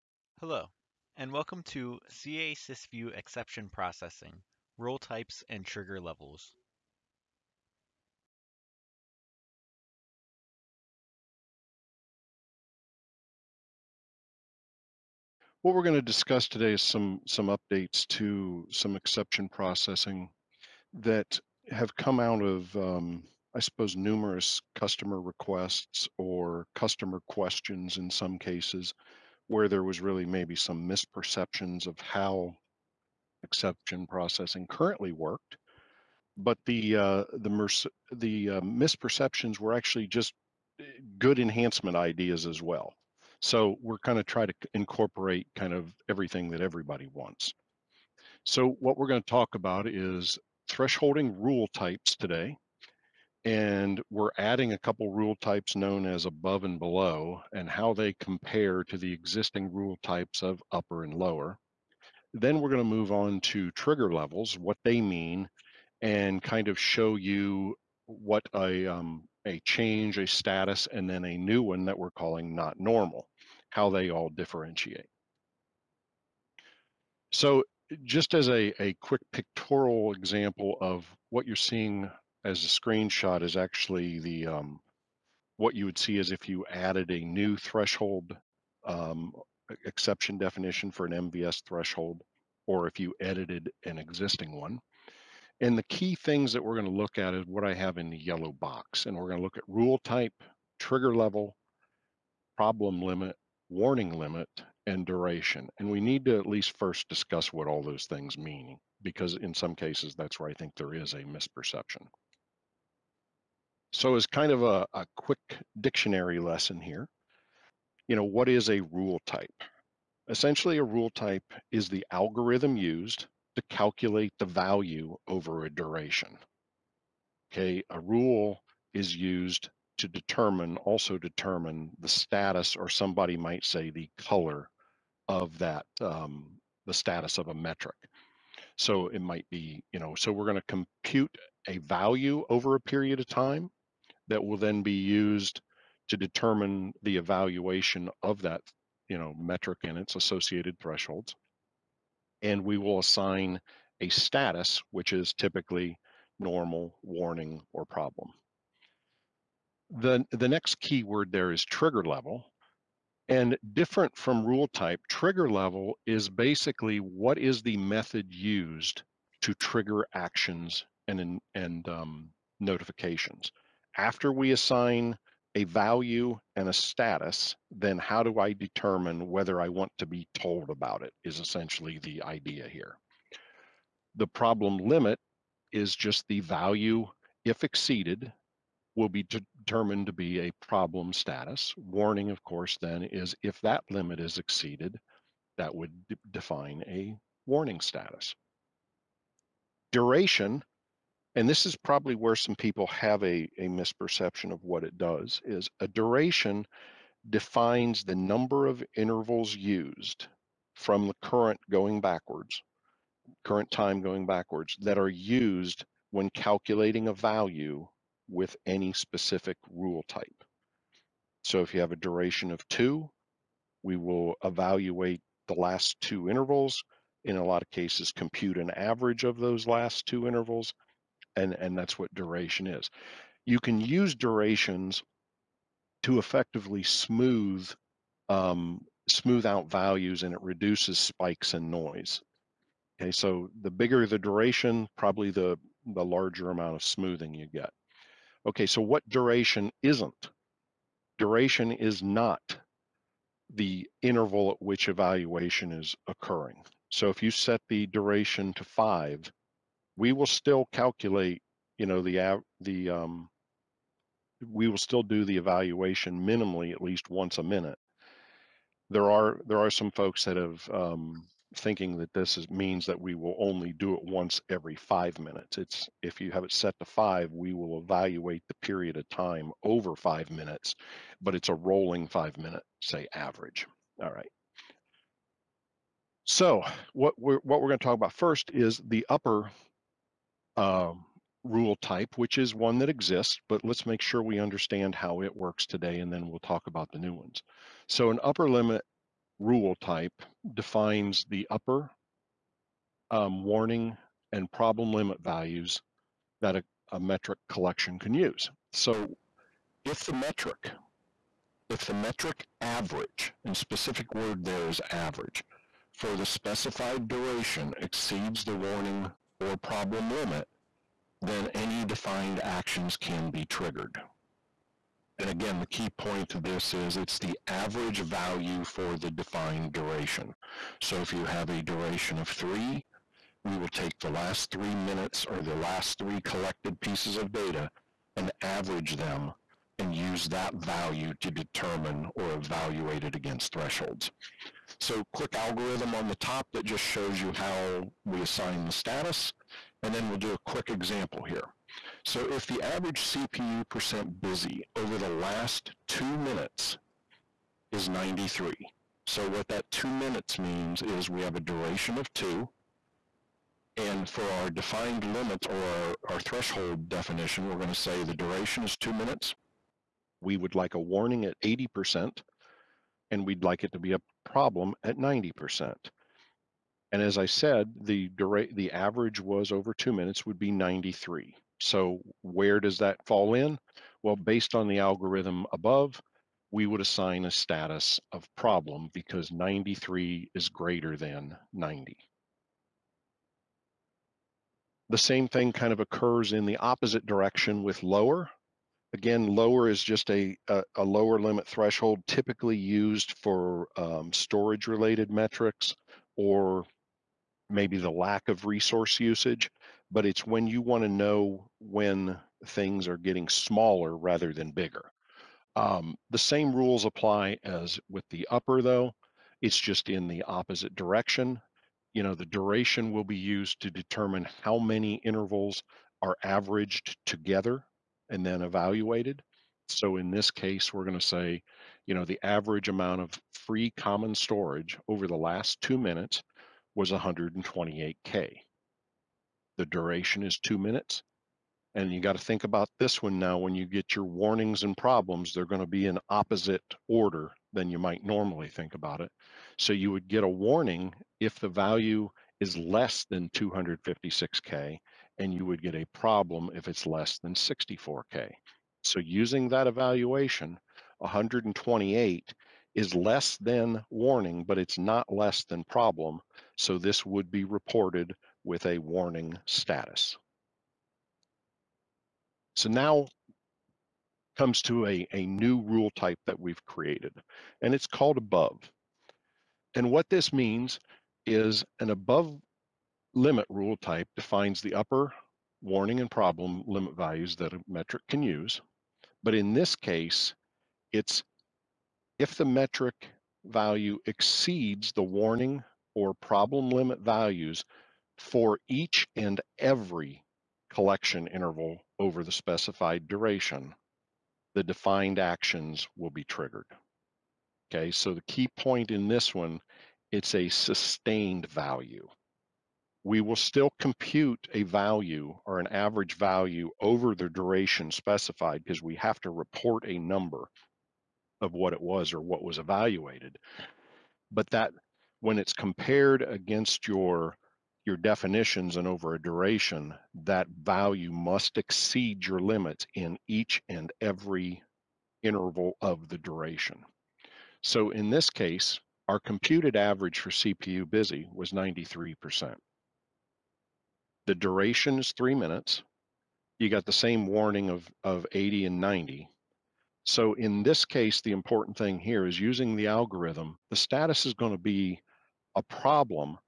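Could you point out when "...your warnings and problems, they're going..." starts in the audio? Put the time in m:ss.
7:23.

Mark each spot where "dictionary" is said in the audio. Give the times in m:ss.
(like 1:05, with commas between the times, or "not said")
1:55.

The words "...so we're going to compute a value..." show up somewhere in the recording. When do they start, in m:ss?
2:20.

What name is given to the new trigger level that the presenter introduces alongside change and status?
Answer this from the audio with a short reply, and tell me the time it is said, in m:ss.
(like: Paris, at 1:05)
not normal, at 1:12.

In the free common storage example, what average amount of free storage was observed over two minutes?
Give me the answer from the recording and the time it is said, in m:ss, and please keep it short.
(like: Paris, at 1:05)
128K, at 7:16.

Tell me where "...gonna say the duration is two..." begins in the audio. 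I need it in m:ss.
6:07.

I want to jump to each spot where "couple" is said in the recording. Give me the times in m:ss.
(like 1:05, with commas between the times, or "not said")
0:54.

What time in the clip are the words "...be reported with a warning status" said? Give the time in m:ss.
7:47.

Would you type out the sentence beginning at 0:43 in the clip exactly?
So we're kind of try to incorporate kind of everything that everybody wants.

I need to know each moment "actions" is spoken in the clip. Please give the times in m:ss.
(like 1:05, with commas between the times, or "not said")
2:50, 5:22, 8:25.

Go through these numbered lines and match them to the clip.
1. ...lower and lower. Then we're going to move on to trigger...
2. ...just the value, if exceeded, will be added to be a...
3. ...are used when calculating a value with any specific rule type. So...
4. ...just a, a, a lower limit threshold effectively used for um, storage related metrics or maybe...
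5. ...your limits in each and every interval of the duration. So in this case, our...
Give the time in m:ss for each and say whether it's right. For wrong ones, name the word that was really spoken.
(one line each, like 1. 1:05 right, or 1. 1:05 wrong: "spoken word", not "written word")
1. 1:00 wrong: "upper", not "lower"
2. 3:05 wrong: "determined", not "added"
3. 3:34 right
4. 6:39 wrong: "typically", not "effectively"
5. 8:52 right.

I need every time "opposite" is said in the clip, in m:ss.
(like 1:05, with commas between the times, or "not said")
6:36, 7:00, 7:26.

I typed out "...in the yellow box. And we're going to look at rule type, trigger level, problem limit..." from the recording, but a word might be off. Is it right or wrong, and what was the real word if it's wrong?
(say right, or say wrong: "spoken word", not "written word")
right.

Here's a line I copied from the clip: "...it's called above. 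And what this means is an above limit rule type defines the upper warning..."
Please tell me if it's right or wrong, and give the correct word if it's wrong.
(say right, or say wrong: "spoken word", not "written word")
right.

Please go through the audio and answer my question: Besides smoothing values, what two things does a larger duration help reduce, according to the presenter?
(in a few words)
spikes and noise.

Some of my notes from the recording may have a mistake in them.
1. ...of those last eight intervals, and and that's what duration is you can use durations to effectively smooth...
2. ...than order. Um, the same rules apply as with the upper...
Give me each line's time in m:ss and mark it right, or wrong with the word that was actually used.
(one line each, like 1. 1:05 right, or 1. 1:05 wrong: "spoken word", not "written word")
1. 3:49 wrong: "two", not "eight"
2. 6:54 wrong: "bigger", not "order".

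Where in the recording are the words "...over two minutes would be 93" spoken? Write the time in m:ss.
6:19.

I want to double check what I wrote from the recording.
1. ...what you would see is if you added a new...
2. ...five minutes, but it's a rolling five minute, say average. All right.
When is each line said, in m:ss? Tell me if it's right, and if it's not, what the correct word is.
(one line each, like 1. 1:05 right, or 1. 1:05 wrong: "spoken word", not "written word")
1. 1:25 right
2. 4:39 right.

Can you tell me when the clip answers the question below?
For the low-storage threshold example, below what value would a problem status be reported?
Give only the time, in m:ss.
7:37.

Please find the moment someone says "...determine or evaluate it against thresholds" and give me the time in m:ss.
5:41.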